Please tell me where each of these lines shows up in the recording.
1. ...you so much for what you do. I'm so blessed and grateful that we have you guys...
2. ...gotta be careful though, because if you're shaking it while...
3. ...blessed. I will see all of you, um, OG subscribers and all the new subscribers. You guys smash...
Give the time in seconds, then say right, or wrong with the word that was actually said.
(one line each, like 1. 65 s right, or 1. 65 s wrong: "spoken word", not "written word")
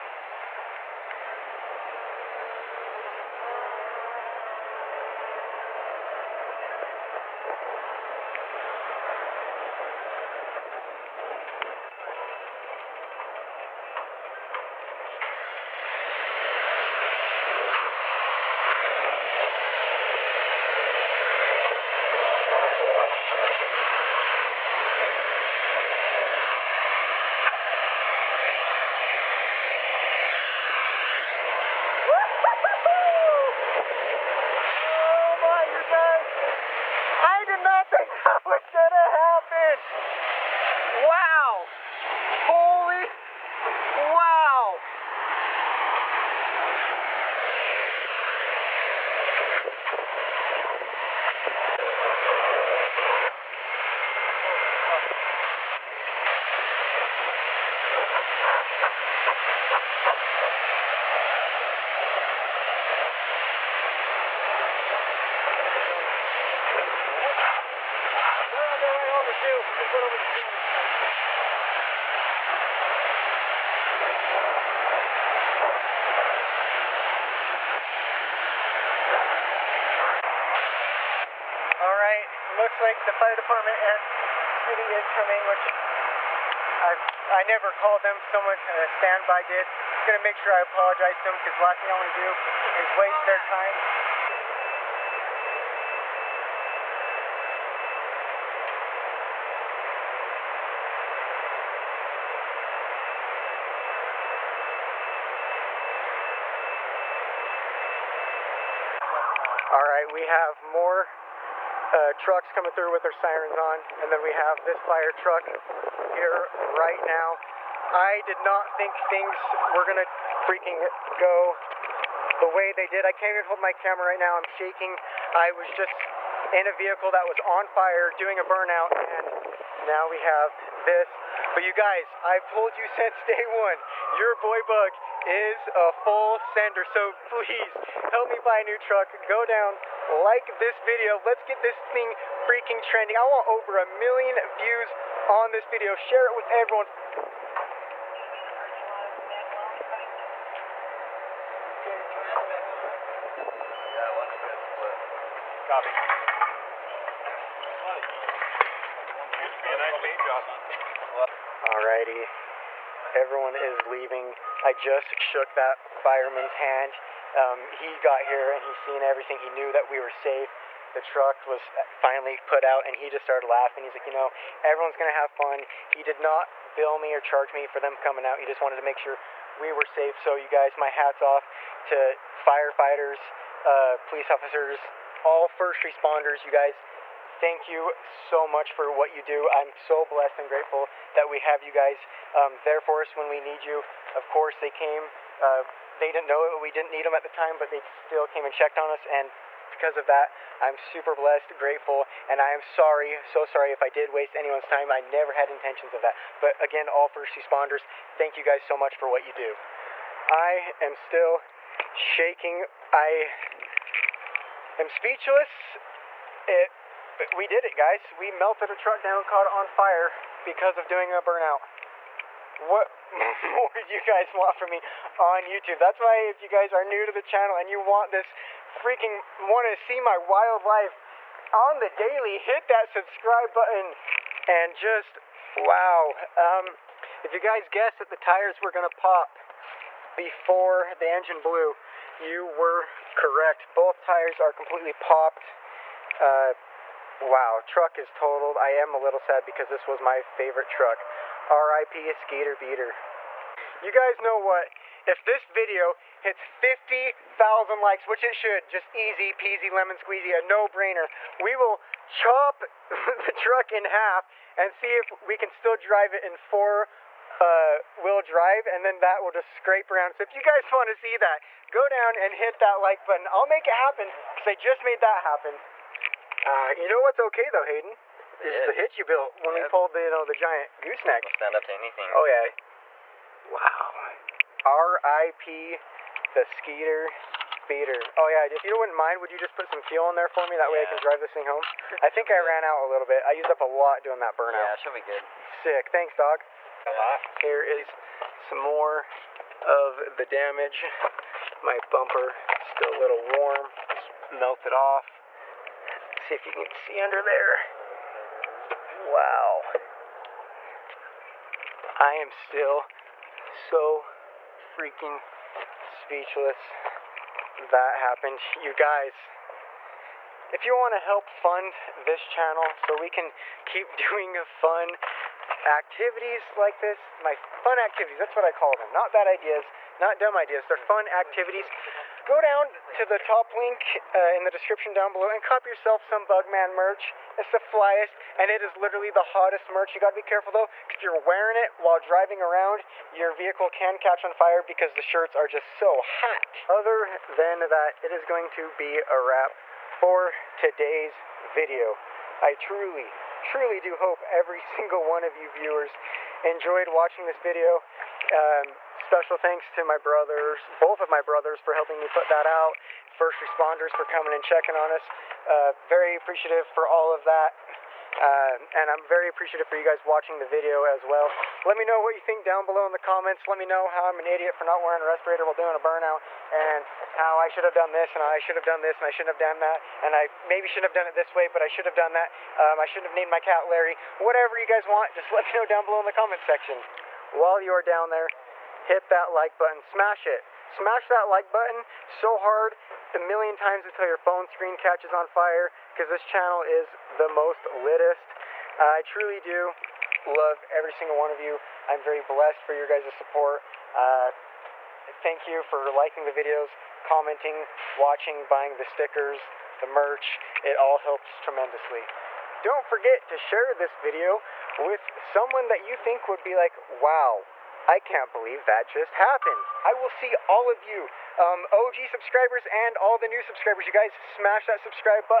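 1. 187 s right
2. 340 s wrong: "wearing", not "shaking"
3. 419 s wrong: "happened", not "blessed".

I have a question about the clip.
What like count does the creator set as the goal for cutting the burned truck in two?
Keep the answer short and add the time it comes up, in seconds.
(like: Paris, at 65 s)
50,000, at 256 s.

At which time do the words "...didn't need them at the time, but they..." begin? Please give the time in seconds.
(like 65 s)
196 s.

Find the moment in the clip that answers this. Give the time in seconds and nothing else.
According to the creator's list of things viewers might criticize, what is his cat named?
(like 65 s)
383 s.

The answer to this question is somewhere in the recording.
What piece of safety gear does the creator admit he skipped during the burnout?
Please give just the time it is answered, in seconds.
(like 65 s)
375 s.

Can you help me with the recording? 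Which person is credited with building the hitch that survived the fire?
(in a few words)
Hayden.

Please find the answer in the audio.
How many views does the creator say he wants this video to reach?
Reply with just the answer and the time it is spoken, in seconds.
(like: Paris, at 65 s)
over a million, at 143 s.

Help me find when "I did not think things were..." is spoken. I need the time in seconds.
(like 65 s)
117 s.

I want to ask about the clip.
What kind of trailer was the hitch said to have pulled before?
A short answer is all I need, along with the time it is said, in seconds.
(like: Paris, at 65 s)
giant gooseneck, at 280 s.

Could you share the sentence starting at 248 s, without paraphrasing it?
I am a little sad because this was my favorite truck.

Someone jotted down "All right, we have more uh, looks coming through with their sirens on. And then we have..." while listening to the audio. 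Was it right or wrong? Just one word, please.
wrong.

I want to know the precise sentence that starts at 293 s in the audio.
I used up a lot doing that burnout.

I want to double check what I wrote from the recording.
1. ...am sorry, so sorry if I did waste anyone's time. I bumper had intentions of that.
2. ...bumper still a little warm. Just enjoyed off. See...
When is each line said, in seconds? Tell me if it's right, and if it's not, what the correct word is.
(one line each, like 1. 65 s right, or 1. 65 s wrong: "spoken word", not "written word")
1. 202 s wrong: "never", not "bumper"
2. 301 s wrong: "melted", not "enjoyed".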